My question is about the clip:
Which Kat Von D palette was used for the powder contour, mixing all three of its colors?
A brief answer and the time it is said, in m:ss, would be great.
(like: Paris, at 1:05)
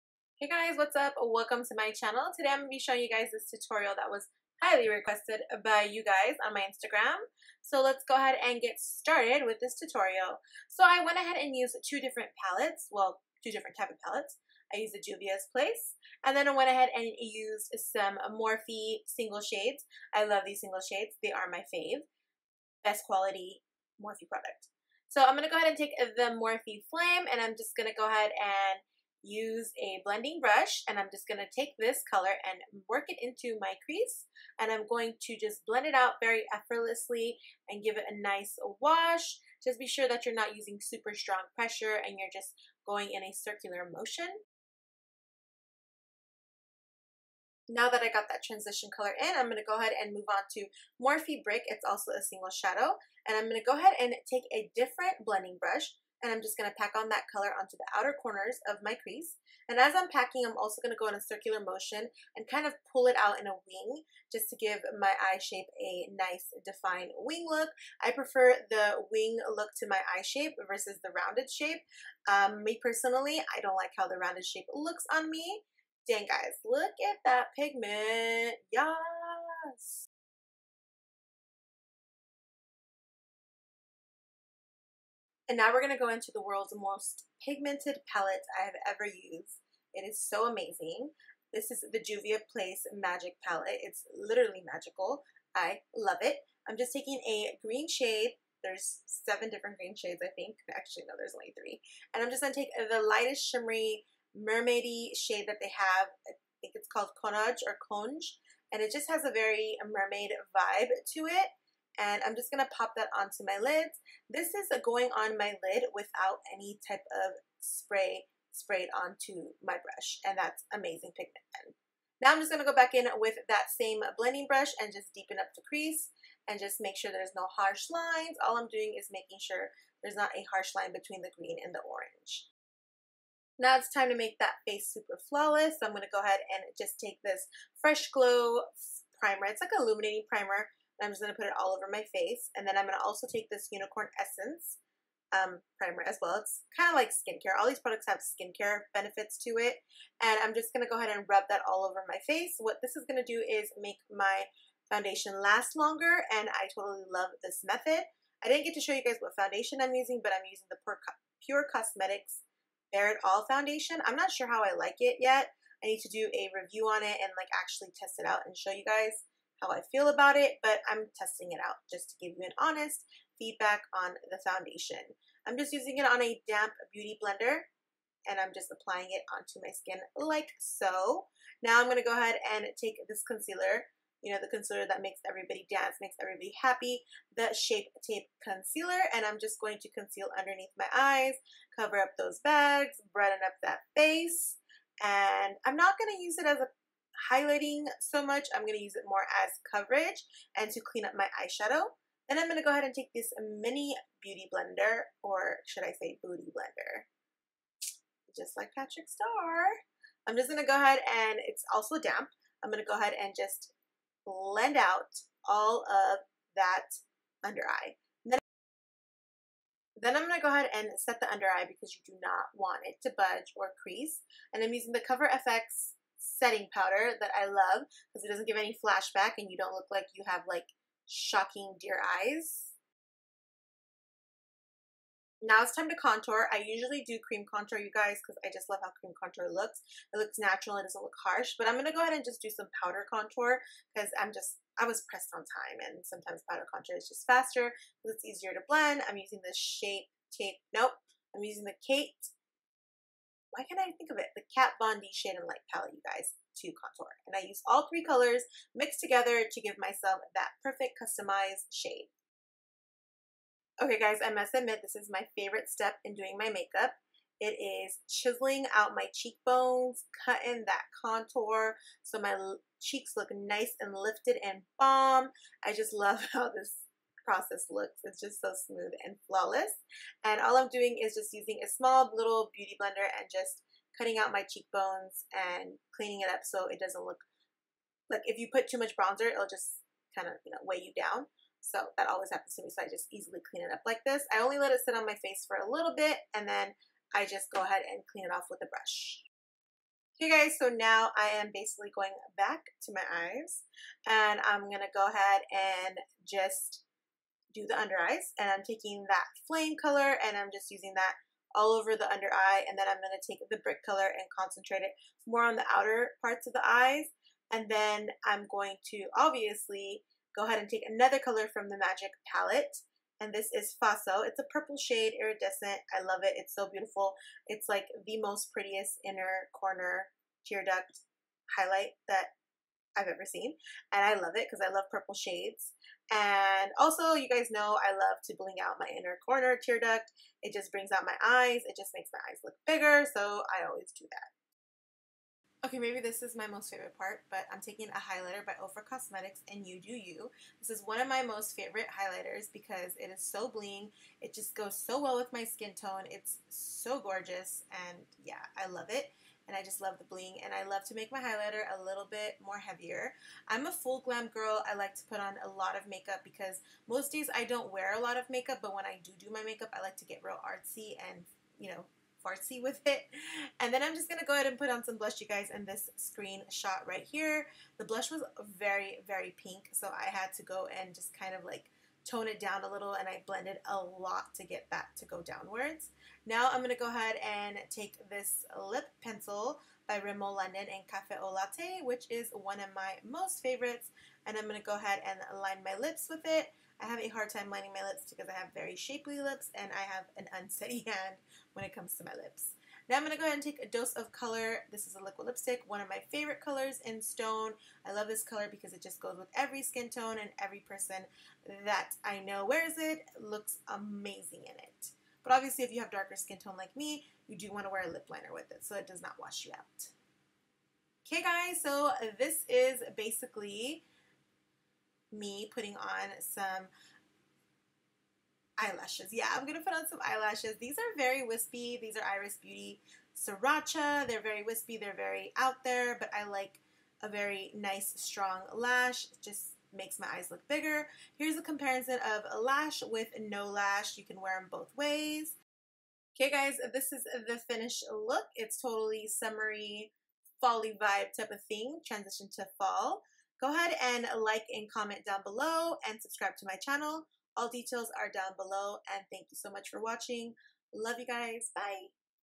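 Shade and Light, at 4:15.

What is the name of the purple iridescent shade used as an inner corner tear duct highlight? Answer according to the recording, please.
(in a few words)
Faso.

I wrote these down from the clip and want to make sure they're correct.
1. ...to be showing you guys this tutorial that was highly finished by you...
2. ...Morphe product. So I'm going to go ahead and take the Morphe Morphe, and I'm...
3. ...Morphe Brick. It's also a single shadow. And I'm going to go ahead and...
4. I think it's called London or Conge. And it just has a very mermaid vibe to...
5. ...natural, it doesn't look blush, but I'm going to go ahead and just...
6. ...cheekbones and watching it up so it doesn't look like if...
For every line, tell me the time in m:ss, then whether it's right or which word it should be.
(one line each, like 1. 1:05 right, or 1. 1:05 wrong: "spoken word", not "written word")
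1. 0:02 wrong: "requested", not "finished"
2. 0:24 wrong: "Flame", not "Morphe"
3. 0:51 right
4. 1:46 wrong: "Conage", not "London"
5. 4:00 wrong: "harsh", not "blush"
6. 4:44 wrong: "cleaning", not "watching".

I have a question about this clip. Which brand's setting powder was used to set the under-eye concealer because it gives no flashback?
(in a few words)
Cover FX.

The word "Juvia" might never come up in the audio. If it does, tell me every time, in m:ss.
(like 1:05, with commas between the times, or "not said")
0:15, 1:31.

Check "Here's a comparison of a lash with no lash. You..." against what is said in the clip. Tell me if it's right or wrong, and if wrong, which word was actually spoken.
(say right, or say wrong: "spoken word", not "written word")
right.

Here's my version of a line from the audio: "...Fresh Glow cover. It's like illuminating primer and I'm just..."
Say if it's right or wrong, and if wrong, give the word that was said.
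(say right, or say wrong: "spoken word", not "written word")
wrong: "primer", not "cover".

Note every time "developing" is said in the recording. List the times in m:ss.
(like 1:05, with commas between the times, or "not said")
not said.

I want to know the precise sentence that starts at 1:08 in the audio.
I prefer the wing look to my eye shape versus the rounded shape.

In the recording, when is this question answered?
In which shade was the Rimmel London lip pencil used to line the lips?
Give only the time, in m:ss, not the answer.
6:30.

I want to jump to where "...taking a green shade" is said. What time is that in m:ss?
1:36.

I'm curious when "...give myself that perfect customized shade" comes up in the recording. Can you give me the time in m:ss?
4:19.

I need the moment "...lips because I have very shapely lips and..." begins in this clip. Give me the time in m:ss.
6:37.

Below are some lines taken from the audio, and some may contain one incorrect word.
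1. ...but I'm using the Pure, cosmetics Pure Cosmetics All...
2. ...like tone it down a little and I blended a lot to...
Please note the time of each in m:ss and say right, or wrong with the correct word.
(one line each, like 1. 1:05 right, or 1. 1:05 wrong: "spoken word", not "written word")
1. 2:40 right
2. 6:21 right.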